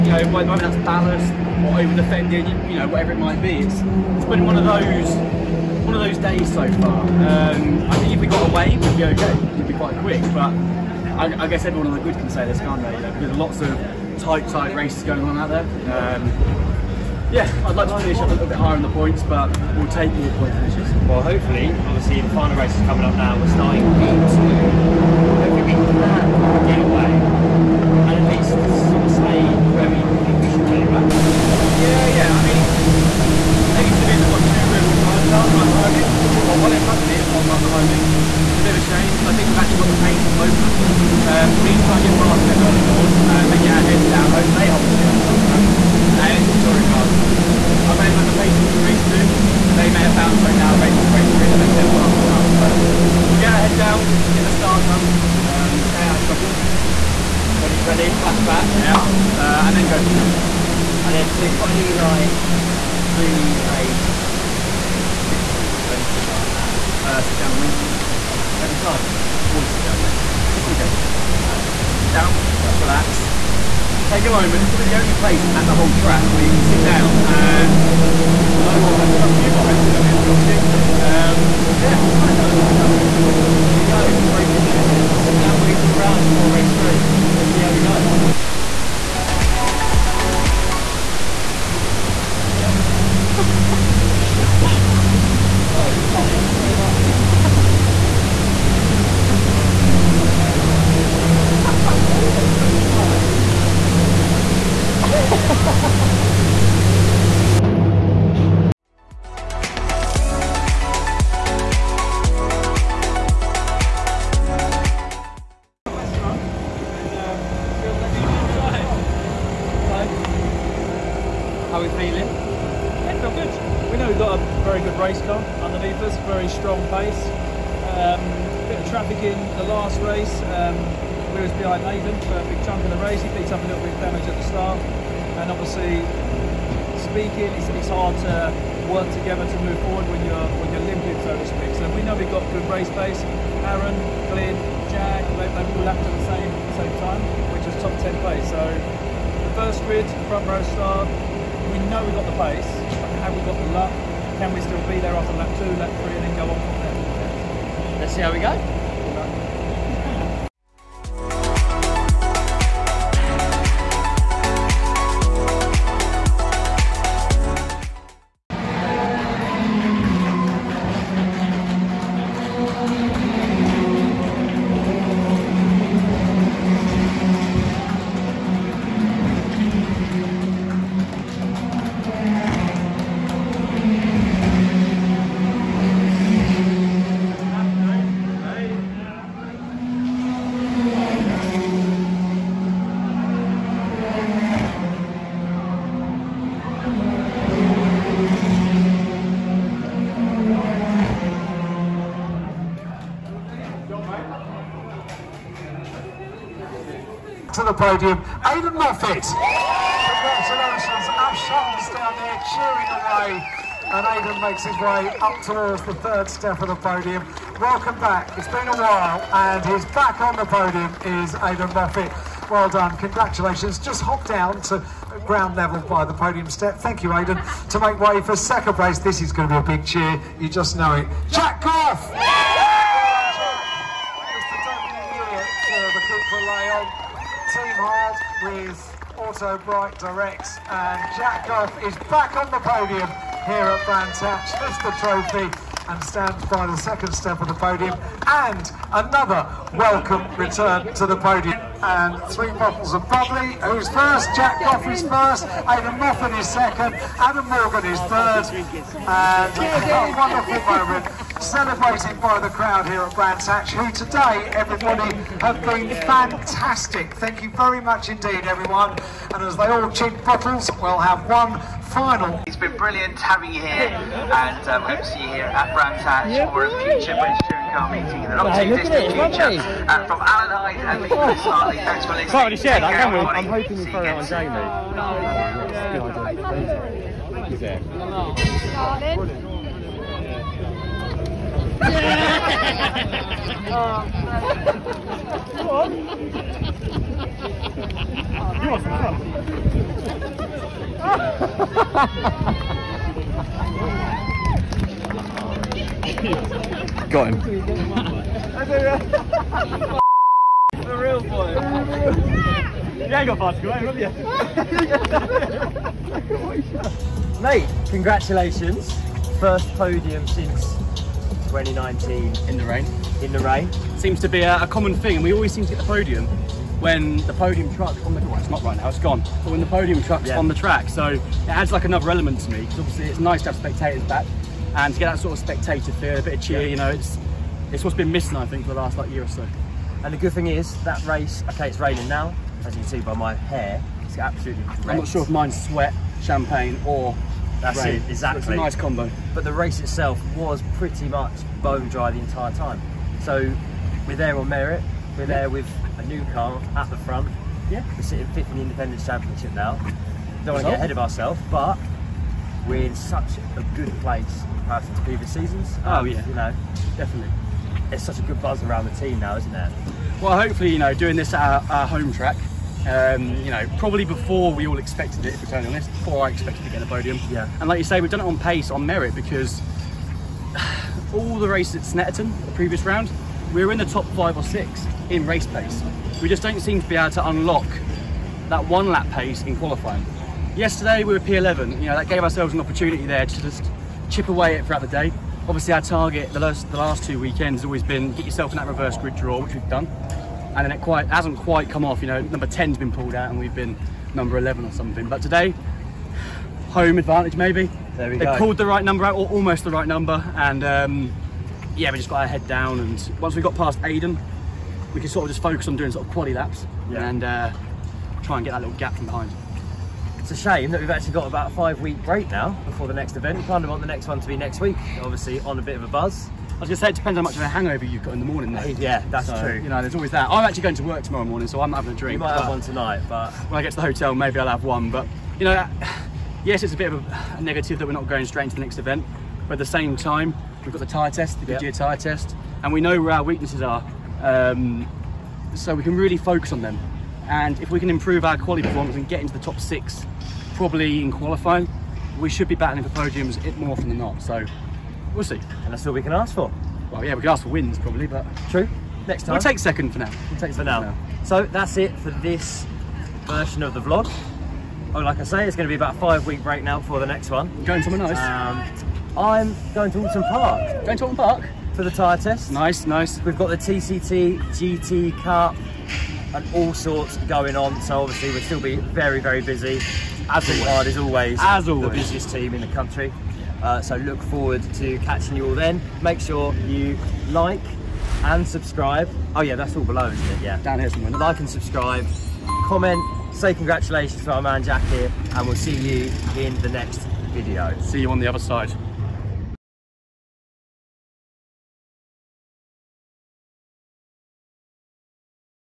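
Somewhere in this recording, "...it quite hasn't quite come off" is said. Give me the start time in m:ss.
6:40.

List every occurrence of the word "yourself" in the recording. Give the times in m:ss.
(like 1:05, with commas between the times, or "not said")
6:38.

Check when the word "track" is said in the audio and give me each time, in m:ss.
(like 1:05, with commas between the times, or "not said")
1:16, 5:30, 6:12.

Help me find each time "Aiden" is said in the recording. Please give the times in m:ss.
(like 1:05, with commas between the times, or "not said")
3:28, 3:34, 3:41, 3:47, 4:15, 6:53.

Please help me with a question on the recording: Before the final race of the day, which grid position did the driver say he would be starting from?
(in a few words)
P2.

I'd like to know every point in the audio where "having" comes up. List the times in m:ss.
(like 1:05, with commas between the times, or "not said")
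4:33, 7:11.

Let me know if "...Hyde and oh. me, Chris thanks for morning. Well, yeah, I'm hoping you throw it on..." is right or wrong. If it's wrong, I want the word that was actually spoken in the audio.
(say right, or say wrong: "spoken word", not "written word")
wrong: "listening", not "morning".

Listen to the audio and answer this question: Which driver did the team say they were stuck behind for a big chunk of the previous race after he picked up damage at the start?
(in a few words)
Nathan.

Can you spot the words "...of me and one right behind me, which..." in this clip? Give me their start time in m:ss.
0:36.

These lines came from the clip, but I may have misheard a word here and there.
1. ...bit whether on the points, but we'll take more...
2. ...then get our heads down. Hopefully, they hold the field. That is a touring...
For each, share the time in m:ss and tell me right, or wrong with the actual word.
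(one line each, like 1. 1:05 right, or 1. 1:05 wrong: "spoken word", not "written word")
1. 0:18 wrong: "higher", not "whether"
2. 0:43 right.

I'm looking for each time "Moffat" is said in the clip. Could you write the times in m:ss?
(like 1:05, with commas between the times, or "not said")
3:28, 3:41, 4:15.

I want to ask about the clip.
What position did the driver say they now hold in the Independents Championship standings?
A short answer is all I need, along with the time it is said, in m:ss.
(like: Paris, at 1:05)
Fifth, at 5:58.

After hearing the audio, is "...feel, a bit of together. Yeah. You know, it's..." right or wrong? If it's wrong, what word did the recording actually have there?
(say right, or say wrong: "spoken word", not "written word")
wrong: "cheer", not "together".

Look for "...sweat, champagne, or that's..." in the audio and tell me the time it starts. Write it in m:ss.
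5:45.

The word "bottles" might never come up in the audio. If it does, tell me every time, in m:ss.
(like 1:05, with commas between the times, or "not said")
4:12, 4:30.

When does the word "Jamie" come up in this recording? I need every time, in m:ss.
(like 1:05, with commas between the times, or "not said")
4:44.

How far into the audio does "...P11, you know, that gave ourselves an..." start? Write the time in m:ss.
6:31.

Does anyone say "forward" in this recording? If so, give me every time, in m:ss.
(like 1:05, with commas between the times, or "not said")
2:19, 8:04.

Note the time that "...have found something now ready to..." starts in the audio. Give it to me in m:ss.
0:50.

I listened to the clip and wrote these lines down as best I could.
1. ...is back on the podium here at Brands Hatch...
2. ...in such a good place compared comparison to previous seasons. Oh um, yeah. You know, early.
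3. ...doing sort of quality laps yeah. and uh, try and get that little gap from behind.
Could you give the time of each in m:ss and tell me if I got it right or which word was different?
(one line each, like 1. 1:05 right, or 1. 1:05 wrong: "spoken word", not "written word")
1. 4:01 right
2. 6:02 wrong: "definitely", not "early"
3. 6:55 right.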